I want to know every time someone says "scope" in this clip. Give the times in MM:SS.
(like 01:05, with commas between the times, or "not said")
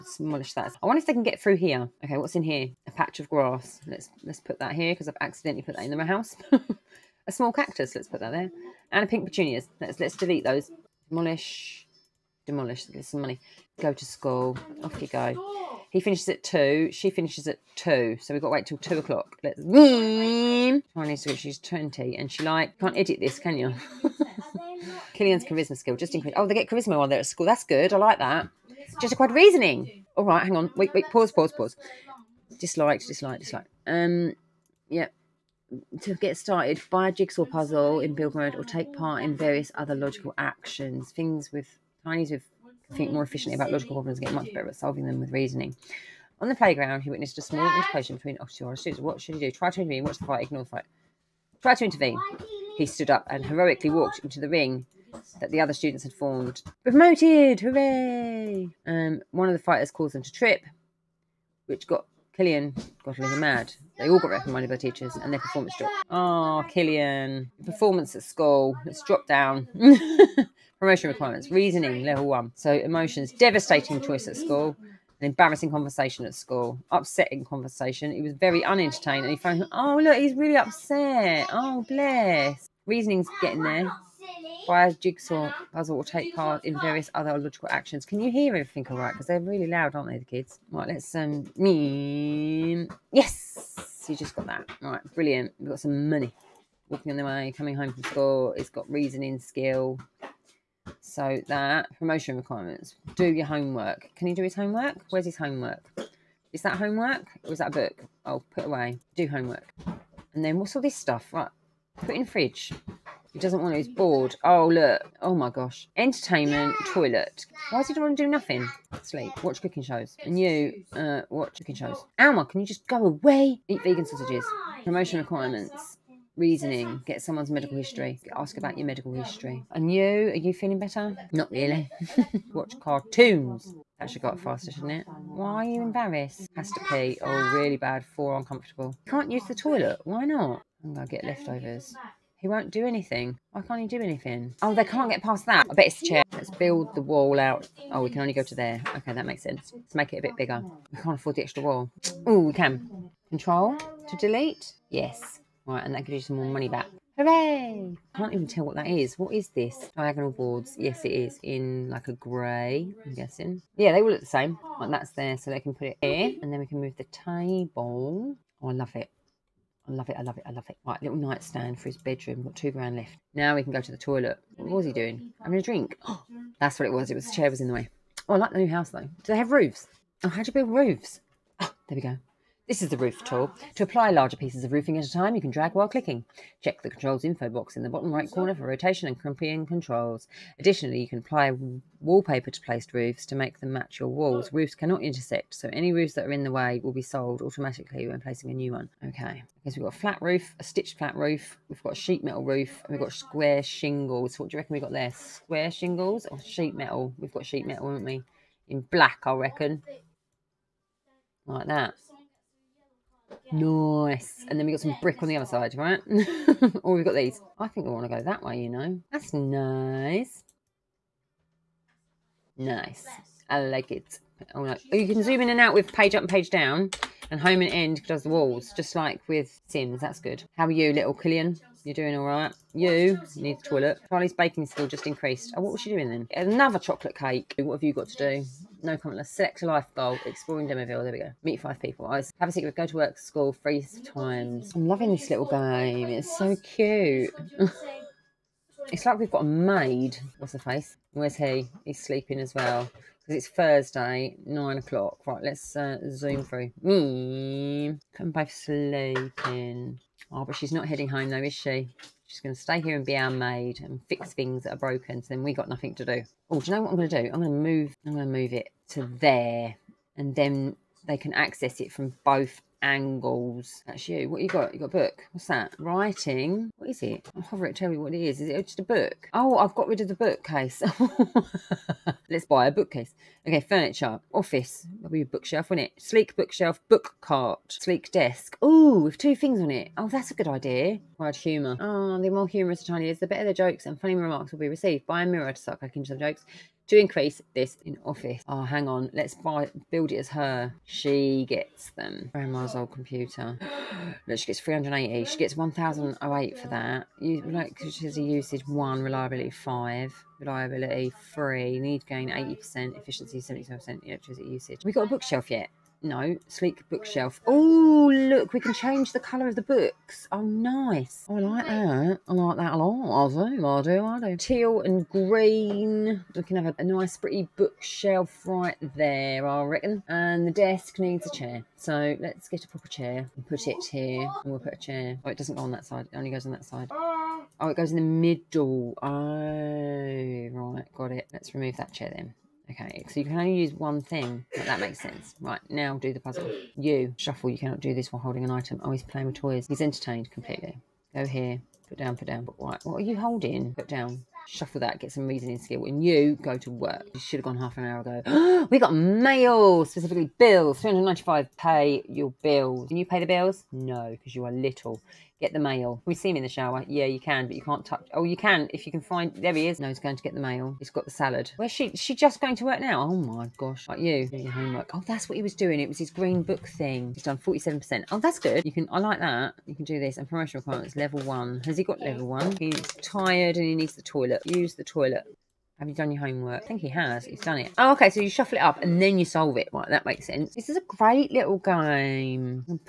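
not said.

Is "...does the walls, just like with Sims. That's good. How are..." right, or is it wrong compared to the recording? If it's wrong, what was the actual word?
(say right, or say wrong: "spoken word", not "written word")
right.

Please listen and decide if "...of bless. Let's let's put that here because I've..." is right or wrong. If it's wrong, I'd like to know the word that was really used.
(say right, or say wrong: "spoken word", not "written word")
wrong: "grass", not "bless".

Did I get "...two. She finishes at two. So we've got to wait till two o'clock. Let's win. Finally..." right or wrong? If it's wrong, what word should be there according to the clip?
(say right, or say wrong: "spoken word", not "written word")
right.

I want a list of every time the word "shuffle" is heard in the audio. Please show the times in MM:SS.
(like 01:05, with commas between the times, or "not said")
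05:47, 05:54, 06:28.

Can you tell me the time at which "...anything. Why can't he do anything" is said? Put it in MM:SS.
02:22.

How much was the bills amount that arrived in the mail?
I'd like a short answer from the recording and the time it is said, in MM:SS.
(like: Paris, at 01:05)
395, at 06:00.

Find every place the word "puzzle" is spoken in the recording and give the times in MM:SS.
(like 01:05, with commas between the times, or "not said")
00:37, 01:25, 05:46.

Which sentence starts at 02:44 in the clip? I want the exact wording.
Like that's there, so they can put it here.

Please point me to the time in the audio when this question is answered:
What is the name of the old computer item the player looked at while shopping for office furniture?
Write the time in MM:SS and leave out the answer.
05:02.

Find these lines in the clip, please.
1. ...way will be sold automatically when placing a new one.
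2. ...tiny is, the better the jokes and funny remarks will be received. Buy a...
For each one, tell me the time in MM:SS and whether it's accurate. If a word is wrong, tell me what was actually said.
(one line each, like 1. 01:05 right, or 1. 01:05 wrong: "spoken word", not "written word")
1. 03:16 right
2. 04:52 right.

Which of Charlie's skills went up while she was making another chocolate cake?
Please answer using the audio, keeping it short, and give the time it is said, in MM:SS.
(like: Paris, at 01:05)
Baking, at 03:54.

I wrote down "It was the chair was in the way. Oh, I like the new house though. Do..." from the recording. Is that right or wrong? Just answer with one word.
right.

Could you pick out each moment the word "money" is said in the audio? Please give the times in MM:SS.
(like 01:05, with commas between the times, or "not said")
00:13, 01:36, 02:36.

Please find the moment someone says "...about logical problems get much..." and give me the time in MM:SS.
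00:43.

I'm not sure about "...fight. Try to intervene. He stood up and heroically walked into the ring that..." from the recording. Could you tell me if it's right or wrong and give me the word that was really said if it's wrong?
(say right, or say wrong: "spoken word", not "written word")
right.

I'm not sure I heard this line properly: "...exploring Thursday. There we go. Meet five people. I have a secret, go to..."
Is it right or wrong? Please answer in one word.
wrong.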